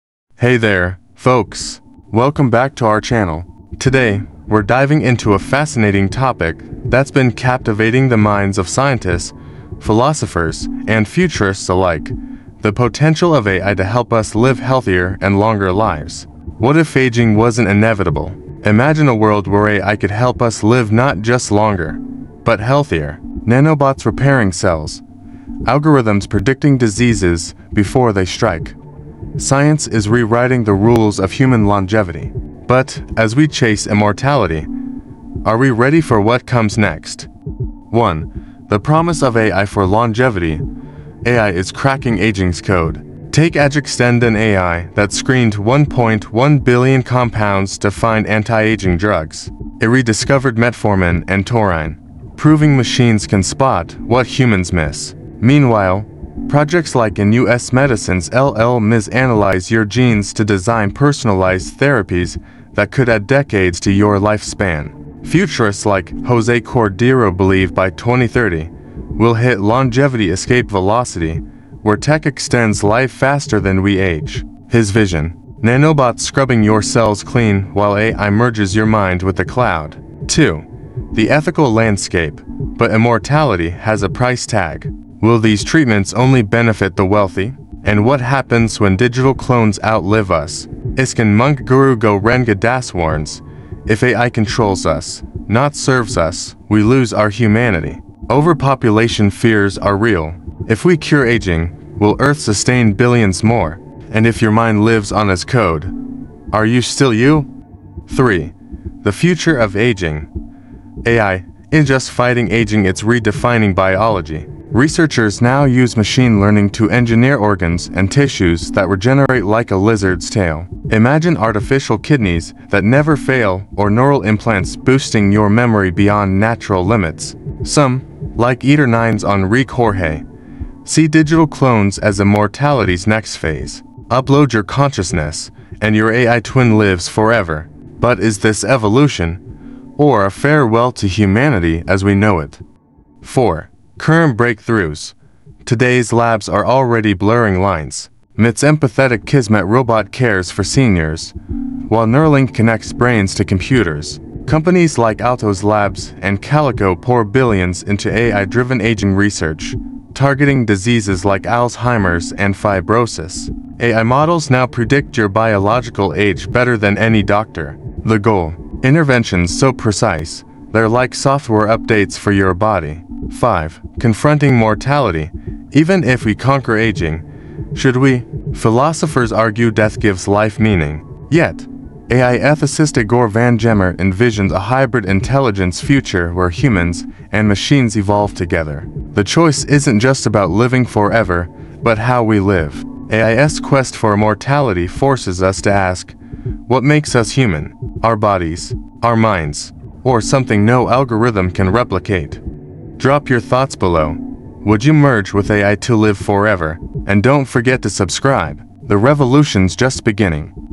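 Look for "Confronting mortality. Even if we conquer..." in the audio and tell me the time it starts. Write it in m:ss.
2:53.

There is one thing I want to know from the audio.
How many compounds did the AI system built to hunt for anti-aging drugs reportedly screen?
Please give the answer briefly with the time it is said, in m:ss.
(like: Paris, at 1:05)
1.1 billion, at 0:45.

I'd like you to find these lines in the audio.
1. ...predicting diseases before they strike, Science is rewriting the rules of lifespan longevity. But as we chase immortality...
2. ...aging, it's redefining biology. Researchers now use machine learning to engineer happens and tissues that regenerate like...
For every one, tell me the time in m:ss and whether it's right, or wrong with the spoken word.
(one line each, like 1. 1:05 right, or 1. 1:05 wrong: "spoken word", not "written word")
1. 0:26 wrong: "human", not "lifespan"
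2. 1:52 wrong: "organs", not "happens".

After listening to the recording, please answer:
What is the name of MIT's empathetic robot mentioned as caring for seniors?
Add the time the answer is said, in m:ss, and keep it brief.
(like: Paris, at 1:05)
Kismet, at 2:29.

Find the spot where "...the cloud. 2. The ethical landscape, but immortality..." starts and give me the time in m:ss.
1:19.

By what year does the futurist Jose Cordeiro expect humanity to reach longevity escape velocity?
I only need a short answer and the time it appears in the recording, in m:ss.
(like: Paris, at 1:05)
2030, at 1:07.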